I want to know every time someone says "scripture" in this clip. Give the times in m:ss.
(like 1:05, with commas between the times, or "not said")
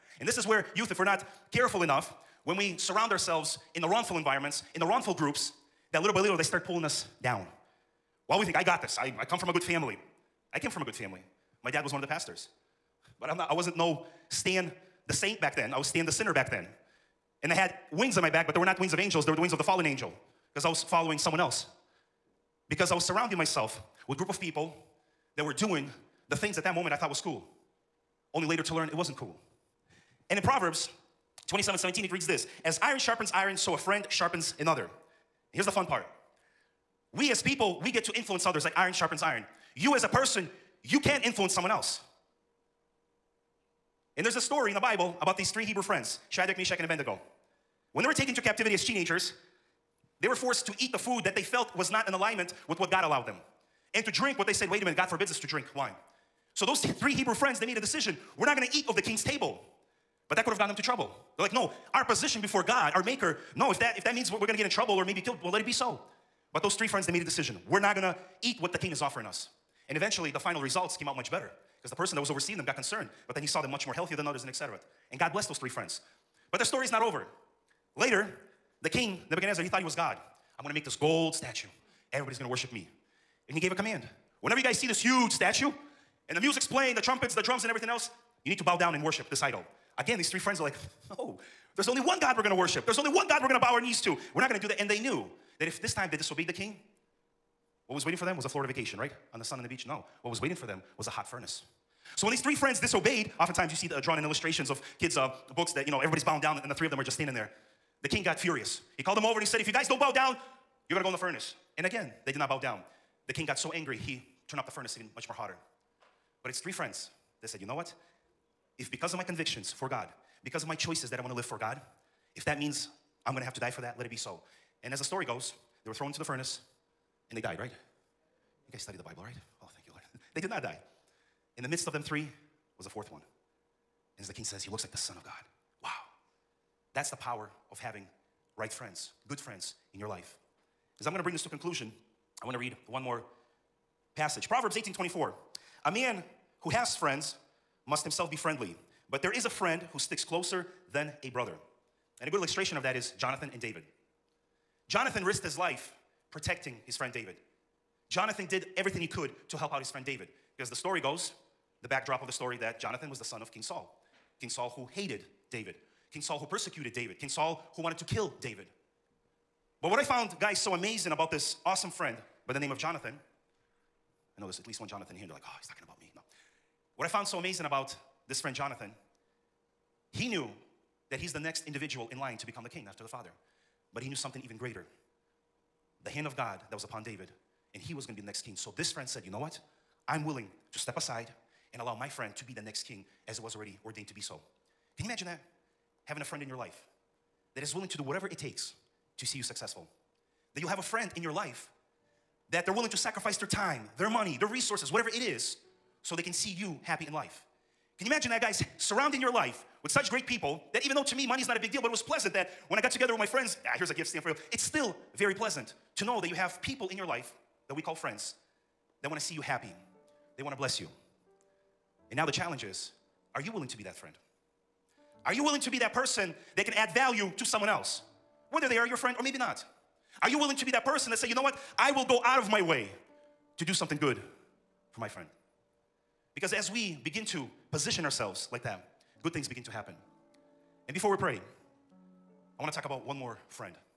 not said.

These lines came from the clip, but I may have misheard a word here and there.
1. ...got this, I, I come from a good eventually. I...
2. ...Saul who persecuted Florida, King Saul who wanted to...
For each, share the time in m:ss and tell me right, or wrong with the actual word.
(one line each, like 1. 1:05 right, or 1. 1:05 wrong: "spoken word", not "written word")
1. 0:08 wrong: "family", not "eventually"
2. 2:46 wrong: "David", not "Florida".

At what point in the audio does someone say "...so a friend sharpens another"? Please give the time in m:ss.
0:33.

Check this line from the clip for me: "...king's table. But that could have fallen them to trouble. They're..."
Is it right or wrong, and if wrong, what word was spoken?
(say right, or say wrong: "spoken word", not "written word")
wrong: "gotten", not "fallen".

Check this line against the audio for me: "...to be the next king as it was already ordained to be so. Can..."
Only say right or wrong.
right.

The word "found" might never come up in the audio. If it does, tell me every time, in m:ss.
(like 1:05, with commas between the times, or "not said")
2:50, 2:57.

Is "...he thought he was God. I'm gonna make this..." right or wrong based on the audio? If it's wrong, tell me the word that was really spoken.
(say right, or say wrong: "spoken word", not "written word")
right.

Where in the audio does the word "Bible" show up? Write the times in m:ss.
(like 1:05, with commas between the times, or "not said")
0:44, 2:09.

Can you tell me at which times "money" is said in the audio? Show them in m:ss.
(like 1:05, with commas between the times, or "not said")
3:24, 3:31.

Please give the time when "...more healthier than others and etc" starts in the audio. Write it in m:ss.
1:13.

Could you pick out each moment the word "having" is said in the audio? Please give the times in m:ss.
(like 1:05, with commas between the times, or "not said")
2:17, 3:16.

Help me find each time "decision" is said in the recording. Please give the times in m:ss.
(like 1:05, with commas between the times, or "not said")
0:57, 1:07.